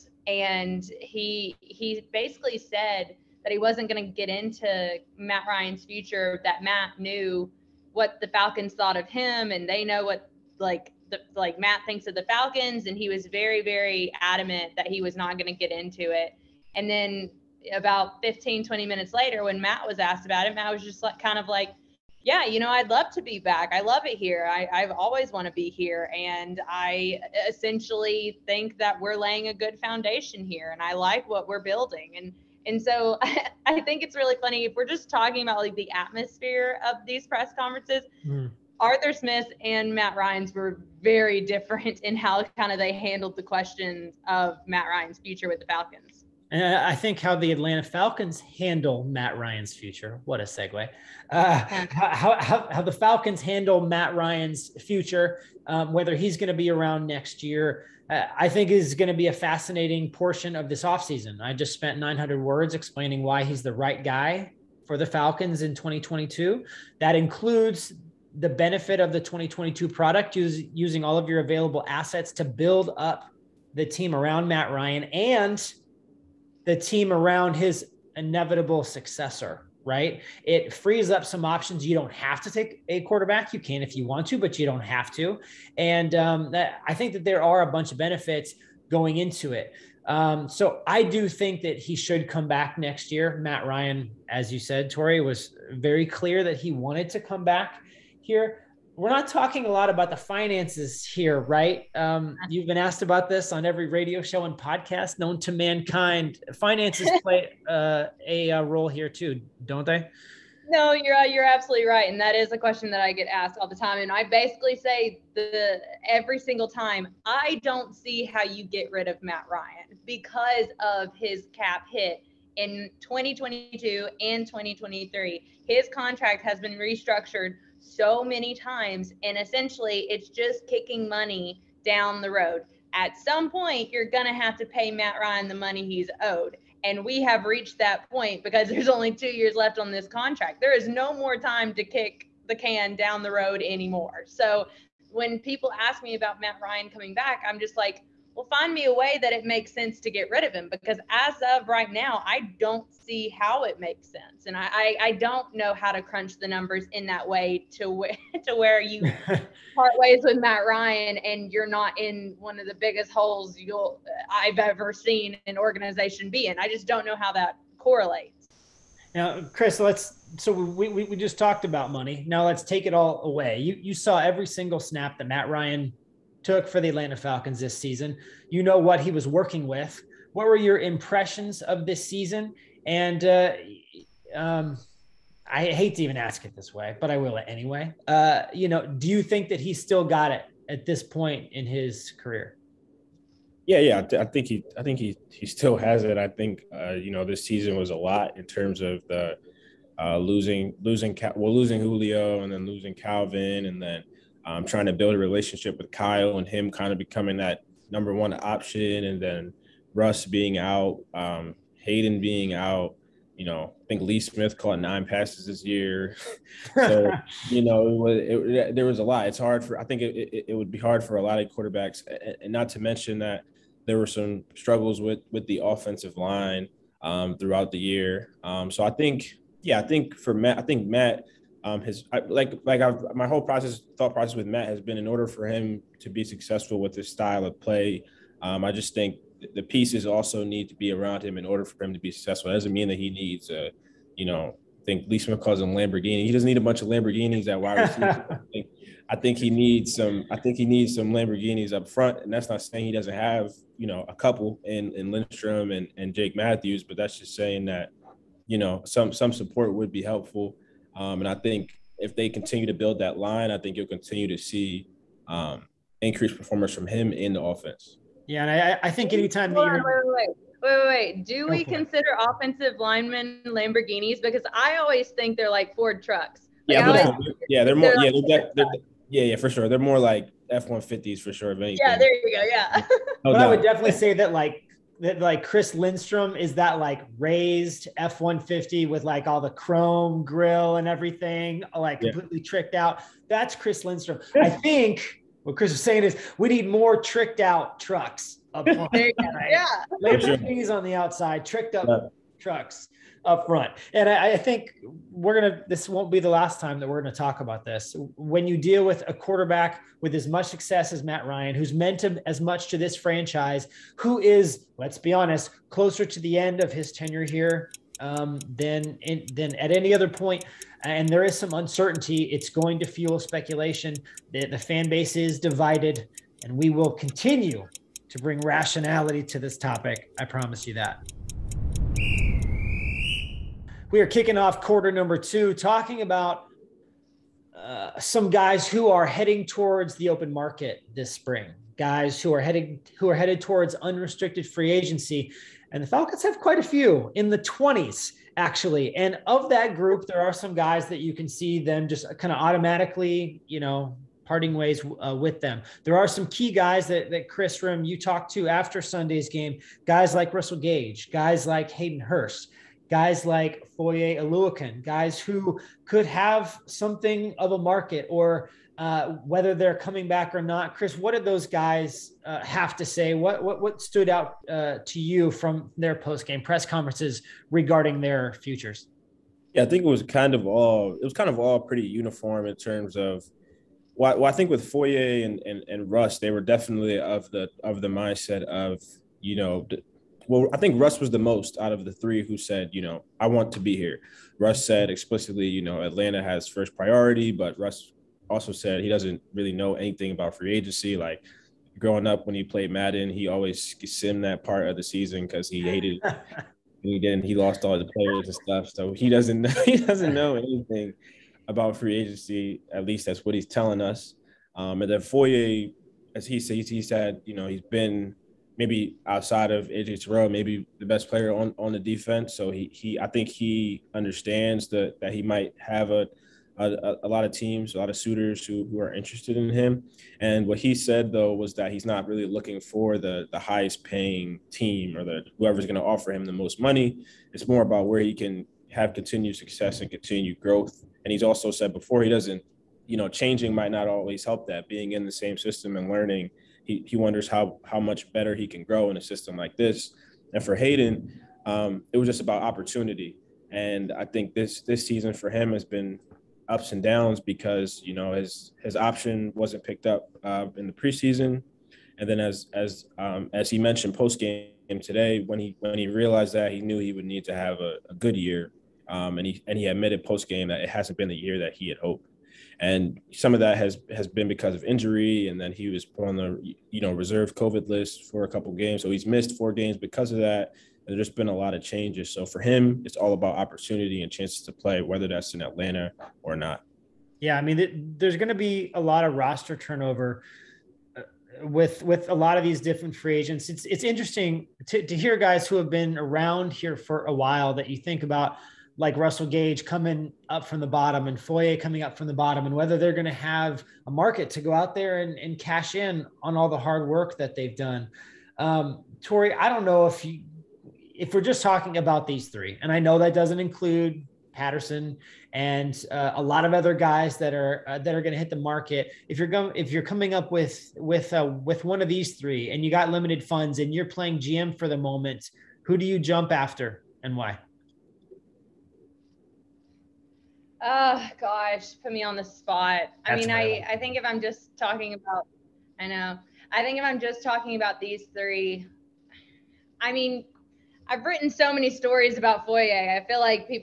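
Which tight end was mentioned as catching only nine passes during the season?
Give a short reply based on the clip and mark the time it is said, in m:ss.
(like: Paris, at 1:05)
Lee Smith, at 3:34.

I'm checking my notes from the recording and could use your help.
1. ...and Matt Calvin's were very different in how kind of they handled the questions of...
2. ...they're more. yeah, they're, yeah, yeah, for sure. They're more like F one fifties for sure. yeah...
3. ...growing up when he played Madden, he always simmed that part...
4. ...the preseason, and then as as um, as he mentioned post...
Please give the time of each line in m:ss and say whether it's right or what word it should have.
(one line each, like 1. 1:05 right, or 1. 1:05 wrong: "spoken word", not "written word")
1. 0:39 wrong: "Ryan", not "Calvin"
2. 4:37 right
3. 6:41 right
4. 7:40 right.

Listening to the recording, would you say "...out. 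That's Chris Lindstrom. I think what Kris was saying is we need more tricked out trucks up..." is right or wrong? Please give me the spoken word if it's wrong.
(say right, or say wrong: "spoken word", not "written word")
right.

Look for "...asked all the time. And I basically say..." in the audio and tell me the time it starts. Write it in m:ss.
1:53.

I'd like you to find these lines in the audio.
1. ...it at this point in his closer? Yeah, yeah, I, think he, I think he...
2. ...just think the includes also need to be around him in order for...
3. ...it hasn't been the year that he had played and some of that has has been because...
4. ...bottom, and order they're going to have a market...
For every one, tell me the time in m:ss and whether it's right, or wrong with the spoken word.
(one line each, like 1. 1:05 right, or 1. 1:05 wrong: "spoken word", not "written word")
1. 3:10 wrong: "career", not "closer"
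2. 3:58 wrong: "pieces", not "includes"
3. 7:50 wrong: "hoped", not "played"
4. 8:22 wrong: "whether", not "order".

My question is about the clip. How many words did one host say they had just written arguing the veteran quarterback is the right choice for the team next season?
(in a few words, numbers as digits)
900.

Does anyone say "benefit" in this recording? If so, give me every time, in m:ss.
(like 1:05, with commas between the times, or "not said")
1:08, 1:27.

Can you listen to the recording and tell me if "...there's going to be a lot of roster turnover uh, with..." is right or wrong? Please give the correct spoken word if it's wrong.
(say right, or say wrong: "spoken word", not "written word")
right.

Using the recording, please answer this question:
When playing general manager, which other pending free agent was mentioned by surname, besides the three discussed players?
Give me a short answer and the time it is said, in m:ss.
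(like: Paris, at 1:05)
Patterson, at 8:34.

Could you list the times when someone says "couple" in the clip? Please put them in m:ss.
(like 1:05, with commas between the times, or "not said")
4:14, 7:58.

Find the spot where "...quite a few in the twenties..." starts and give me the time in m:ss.
5:46.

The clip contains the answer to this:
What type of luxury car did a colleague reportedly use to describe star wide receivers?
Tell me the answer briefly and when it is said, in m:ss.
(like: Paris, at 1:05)
Lamborghini, at 4:05.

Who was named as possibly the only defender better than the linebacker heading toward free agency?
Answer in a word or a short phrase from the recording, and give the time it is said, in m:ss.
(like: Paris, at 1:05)
AJ Terrell, at 6:59.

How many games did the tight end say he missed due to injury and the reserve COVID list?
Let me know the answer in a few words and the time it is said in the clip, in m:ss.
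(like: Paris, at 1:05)
4, at 7:59.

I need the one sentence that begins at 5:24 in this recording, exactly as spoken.
The, the fan base is divided, and we will continue to bring rationality to this topic.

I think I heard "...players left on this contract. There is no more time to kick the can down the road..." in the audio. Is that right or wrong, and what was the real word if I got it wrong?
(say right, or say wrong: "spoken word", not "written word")
wrong: "years", not "players".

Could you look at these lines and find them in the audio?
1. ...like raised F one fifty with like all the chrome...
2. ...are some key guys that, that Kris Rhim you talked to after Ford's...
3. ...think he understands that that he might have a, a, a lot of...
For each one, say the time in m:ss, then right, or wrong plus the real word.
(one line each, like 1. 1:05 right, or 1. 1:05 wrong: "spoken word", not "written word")
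1. 4:46 right
2. 5:55 wrong: "Sunday", not "Ford"
3. 7:03 right.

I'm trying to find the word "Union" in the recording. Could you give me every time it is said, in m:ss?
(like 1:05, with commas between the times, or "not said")
not said.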